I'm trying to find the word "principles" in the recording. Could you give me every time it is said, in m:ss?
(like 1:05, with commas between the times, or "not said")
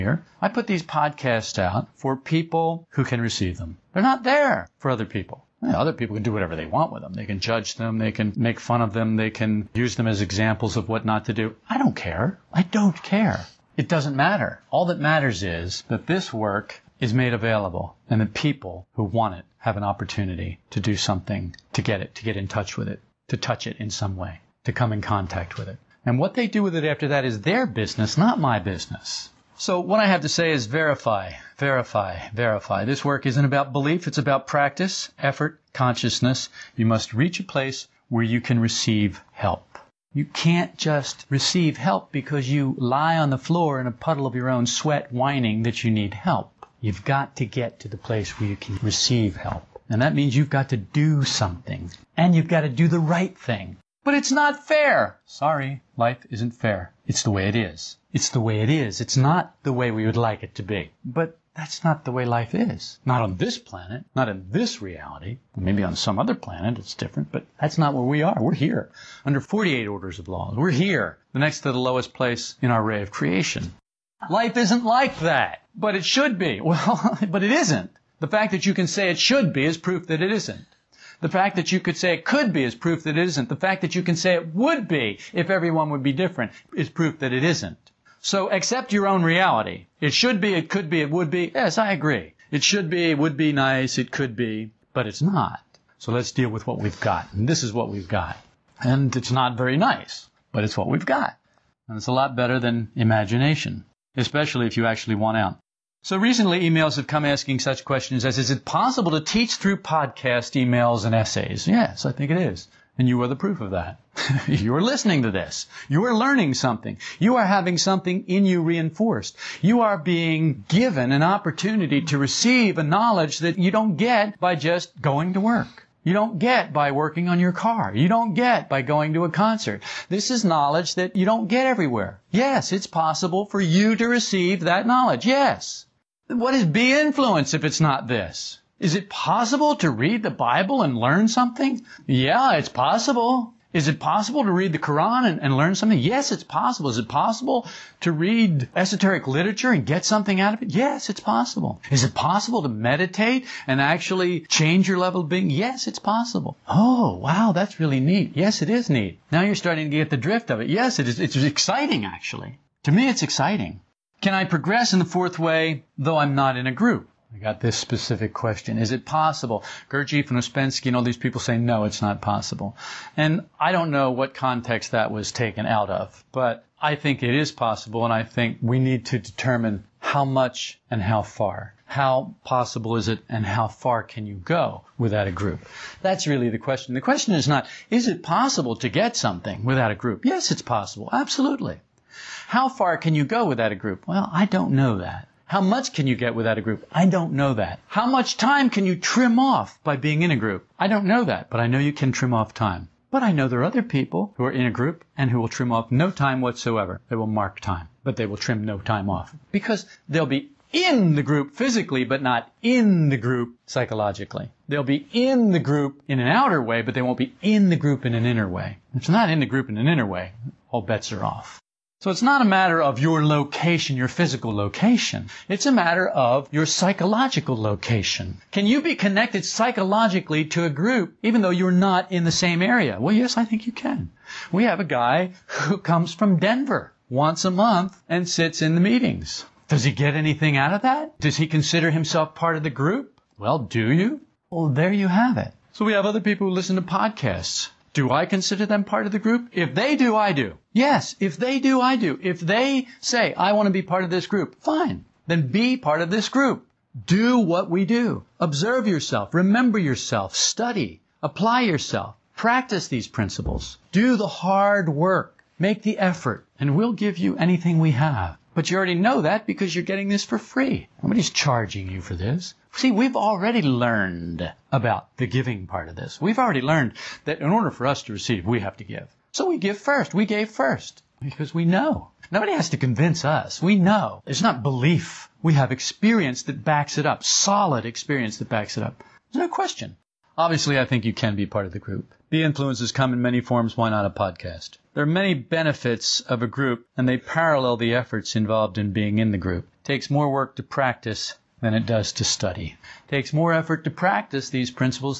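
4:23, 5:04.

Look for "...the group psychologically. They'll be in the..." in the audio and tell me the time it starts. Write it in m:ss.
3:33.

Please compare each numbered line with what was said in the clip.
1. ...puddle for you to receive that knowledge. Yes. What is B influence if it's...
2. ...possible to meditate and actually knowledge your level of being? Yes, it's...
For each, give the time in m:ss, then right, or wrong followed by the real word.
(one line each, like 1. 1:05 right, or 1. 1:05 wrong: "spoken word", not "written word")
1. 2:12 wrong: "possible", not "puddle"
2. 2:32 wrong: "change", not "knowledge".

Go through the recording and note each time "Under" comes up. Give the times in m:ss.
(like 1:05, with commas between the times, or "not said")
1:09.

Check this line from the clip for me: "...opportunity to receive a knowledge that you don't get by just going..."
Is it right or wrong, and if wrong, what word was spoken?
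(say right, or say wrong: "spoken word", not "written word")
right.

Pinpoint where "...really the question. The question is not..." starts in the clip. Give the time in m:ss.
3:06.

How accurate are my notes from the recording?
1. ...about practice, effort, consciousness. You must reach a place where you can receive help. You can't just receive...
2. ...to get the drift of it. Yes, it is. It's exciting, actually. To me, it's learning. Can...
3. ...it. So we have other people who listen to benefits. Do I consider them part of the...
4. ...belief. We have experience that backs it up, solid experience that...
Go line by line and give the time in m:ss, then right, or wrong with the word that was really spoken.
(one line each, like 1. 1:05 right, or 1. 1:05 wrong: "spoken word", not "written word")
1. 0:34 right
2. 2:39 wrong: "exciting", not "learning"
3. 4:05 wrong: "podcasts", not "benefits"
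4. 4:44 right.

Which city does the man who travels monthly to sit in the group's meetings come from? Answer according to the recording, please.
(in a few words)
Denver.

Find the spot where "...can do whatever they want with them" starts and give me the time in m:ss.
0:06.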